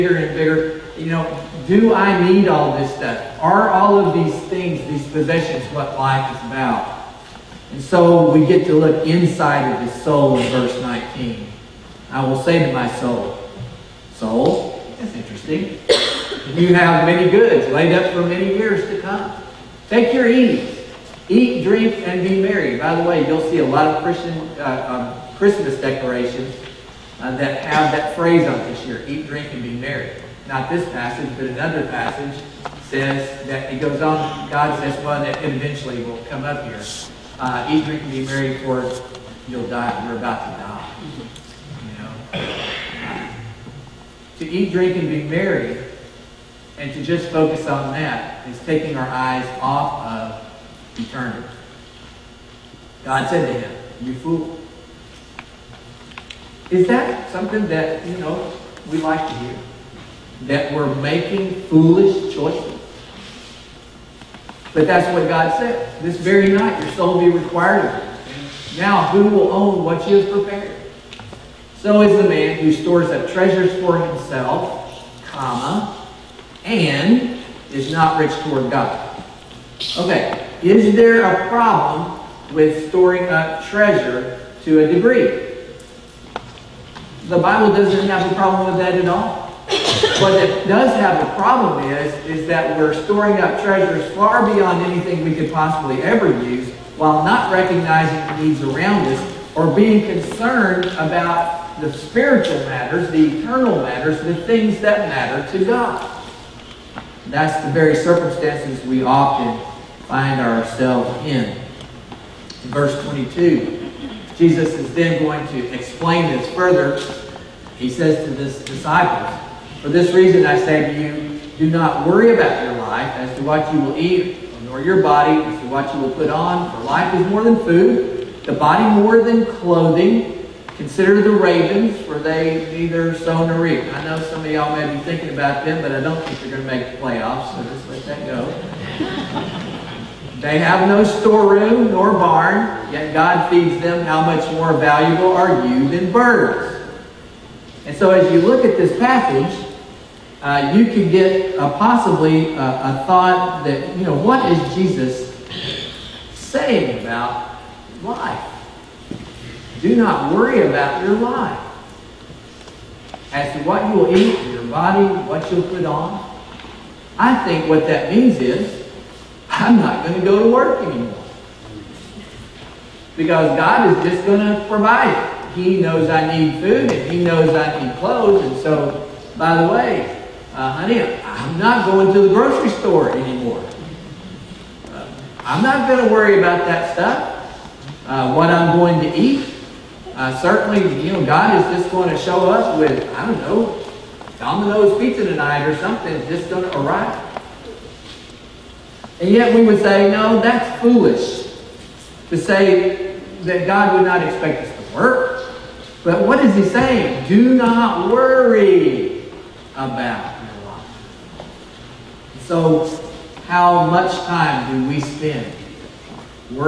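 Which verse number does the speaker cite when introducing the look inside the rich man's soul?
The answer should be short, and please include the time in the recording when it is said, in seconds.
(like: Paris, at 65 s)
19, at 10 s.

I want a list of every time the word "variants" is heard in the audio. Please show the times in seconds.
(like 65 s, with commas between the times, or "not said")
not said.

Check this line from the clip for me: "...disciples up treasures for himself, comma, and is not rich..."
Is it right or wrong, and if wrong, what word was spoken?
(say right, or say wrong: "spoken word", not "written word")
wrong: "stores", not "disciples".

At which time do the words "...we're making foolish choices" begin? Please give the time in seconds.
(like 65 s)
60 s.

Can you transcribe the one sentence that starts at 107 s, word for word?
That's the very circumstances we often find ourselves in.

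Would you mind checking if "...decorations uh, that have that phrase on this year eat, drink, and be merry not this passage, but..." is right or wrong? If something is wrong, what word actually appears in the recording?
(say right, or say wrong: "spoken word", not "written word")
right.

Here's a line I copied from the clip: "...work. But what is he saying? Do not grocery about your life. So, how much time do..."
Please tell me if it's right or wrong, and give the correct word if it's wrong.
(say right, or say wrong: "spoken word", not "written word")
wrong: "worry", not "grocery".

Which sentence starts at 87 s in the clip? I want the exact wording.
The Bible doesn't have a problem with that at all.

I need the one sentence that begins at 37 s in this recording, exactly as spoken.
Uh, eat, drink, and be merry, for you'll die.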